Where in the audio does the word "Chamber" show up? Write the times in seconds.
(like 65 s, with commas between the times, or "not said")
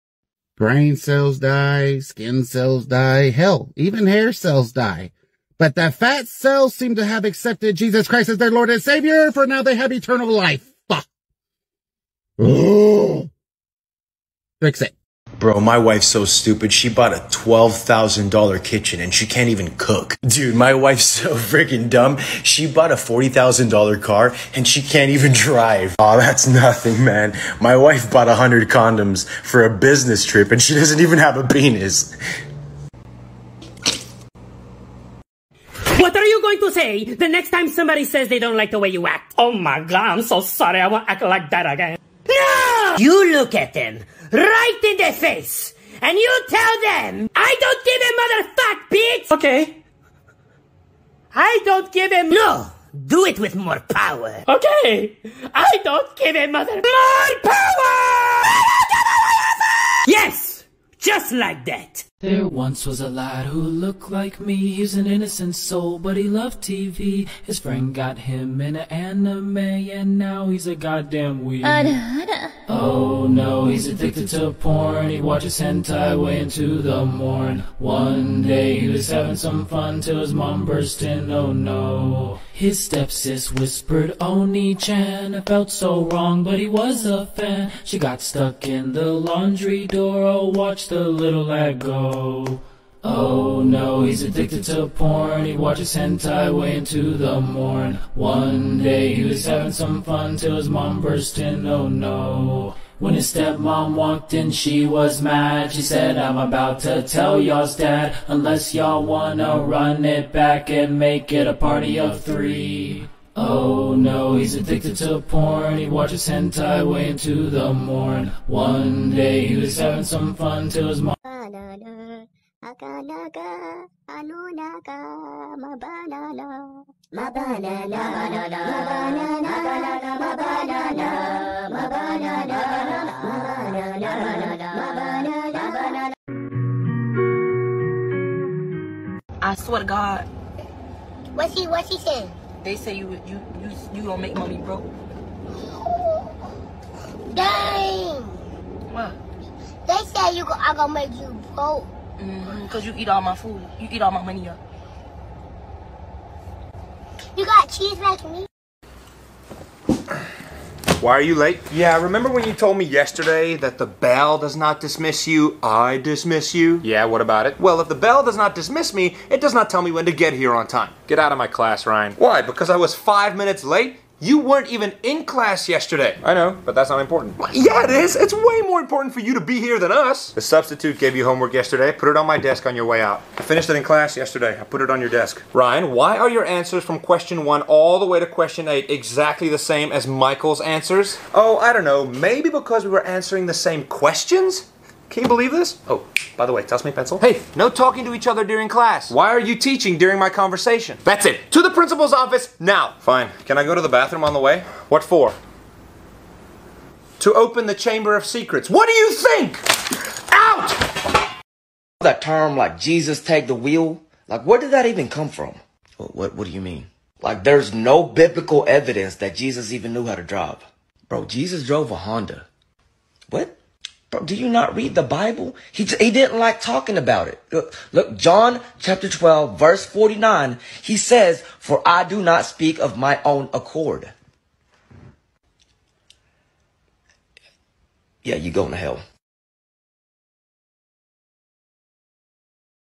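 207 s.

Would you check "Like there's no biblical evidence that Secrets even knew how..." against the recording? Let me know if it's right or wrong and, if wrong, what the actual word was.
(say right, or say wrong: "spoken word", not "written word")
wrong: "Jesus", not "Secrets".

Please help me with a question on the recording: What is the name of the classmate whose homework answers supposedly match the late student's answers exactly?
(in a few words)
Michael.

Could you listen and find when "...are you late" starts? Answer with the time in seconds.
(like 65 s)
161 s.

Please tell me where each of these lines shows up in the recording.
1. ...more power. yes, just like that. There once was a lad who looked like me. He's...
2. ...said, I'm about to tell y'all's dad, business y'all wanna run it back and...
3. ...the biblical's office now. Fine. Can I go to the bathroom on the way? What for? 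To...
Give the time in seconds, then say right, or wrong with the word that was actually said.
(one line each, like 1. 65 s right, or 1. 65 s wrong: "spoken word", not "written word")
1. 56 s right
2. 105 s wrong: "unless", not "business"
3. 201 s wrong: "principal", not "biblical".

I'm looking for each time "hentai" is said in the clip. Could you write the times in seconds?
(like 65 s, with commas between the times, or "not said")
75 s, 95 s, 116 s.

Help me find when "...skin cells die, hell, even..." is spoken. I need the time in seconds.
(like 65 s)
1 s.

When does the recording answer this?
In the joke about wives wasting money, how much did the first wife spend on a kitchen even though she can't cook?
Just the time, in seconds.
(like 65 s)
17 s.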